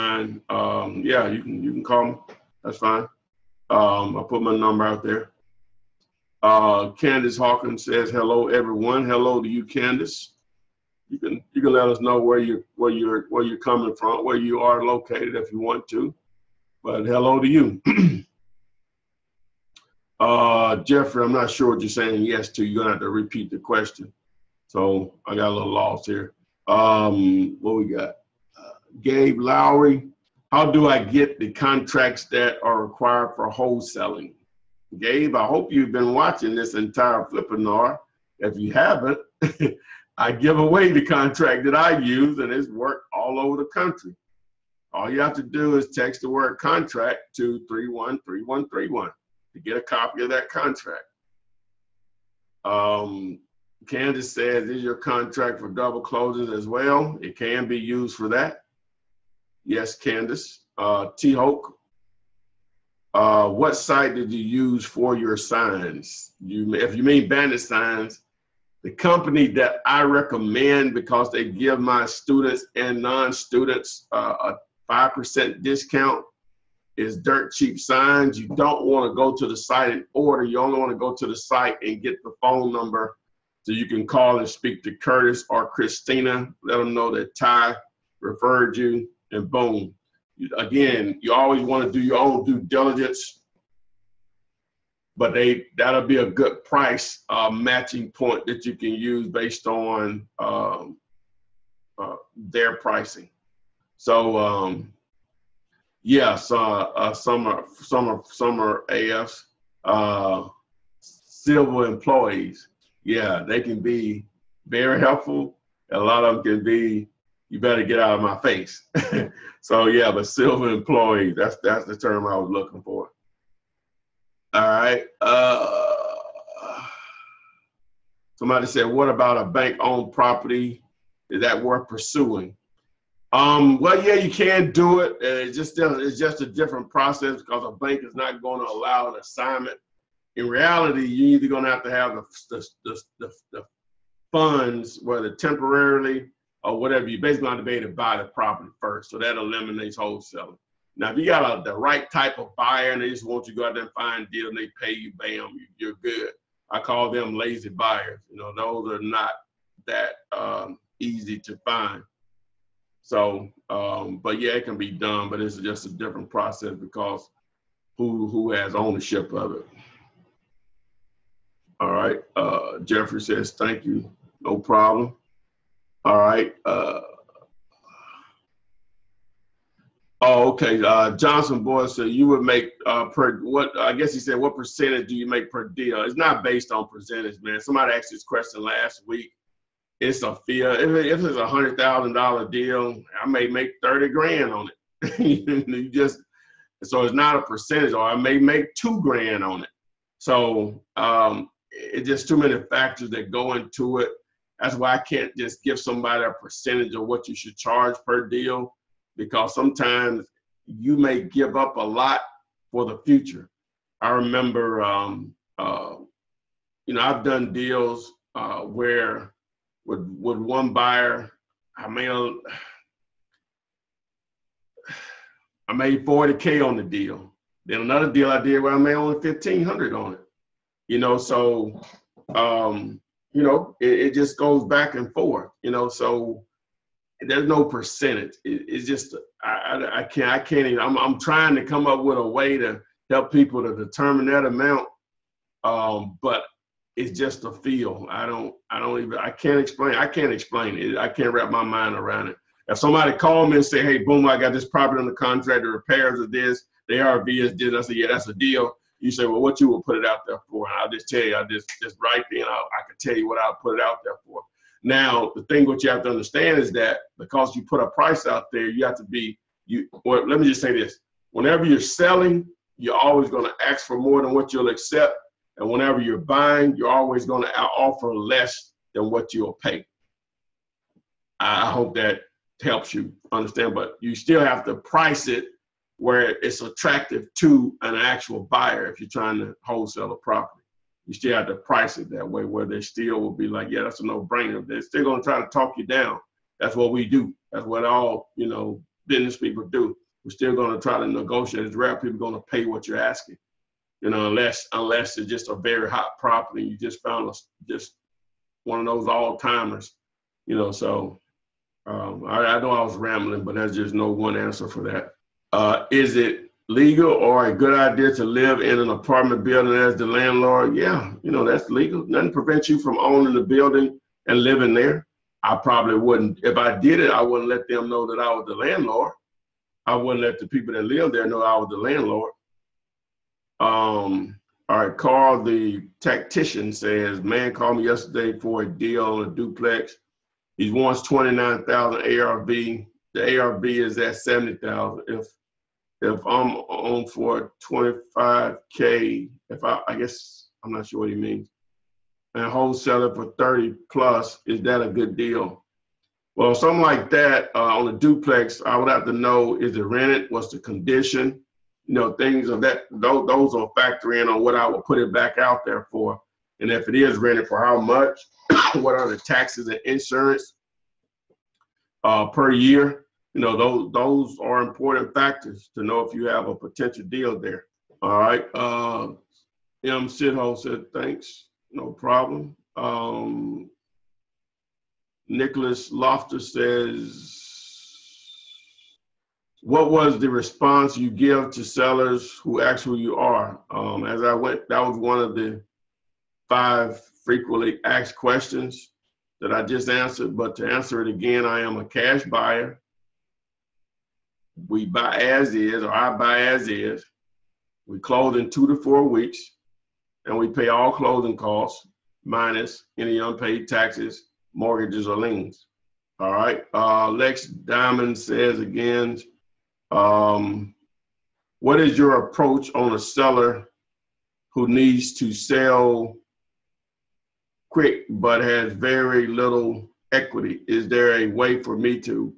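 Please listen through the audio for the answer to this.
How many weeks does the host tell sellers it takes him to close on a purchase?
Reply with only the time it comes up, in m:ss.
6:48.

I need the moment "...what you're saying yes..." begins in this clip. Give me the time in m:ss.
0:21.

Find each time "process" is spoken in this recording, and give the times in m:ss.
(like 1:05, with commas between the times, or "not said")
2:16, 2:46.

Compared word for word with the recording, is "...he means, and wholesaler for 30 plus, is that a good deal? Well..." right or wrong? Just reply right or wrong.
right.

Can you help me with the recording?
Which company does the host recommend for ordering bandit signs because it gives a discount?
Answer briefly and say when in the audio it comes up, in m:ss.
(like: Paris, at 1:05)
Dirt Cheap Signs, at 1:17.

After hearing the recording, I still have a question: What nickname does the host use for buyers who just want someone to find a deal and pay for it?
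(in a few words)
lazy buyers.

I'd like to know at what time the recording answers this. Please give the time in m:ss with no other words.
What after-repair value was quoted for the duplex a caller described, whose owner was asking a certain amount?
5:44.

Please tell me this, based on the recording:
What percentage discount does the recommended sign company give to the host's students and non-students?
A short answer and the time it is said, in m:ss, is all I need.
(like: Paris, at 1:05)
5%, at 1:14.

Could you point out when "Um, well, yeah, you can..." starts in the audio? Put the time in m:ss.
2:13.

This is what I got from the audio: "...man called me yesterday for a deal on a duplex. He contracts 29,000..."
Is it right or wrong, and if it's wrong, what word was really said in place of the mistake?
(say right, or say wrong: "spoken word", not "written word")
wrong: "wants", not "contracts".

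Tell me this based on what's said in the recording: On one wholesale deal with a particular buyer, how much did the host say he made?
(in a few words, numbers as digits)
40k.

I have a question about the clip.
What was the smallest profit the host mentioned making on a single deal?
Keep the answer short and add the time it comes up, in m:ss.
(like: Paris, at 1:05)
1500, at 3:49.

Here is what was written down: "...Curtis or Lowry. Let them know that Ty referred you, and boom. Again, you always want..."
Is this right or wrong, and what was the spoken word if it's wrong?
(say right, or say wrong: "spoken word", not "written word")
wrong: "Christina", not "Lowry".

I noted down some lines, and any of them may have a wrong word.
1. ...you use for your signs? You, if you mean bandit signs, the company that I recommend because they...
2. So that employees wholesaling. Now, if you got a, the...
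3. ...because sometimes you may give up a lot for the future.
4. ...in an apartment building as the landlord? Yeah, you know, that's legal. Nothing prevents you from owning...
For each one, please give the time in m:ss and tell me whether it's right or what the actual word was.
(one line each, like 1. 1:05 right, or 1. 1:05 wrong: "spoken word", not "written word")
1. 1:04 right
2. 2:29 wrong: "eliminates", not "employees"
3. 3:29 right
4. 5:18 right.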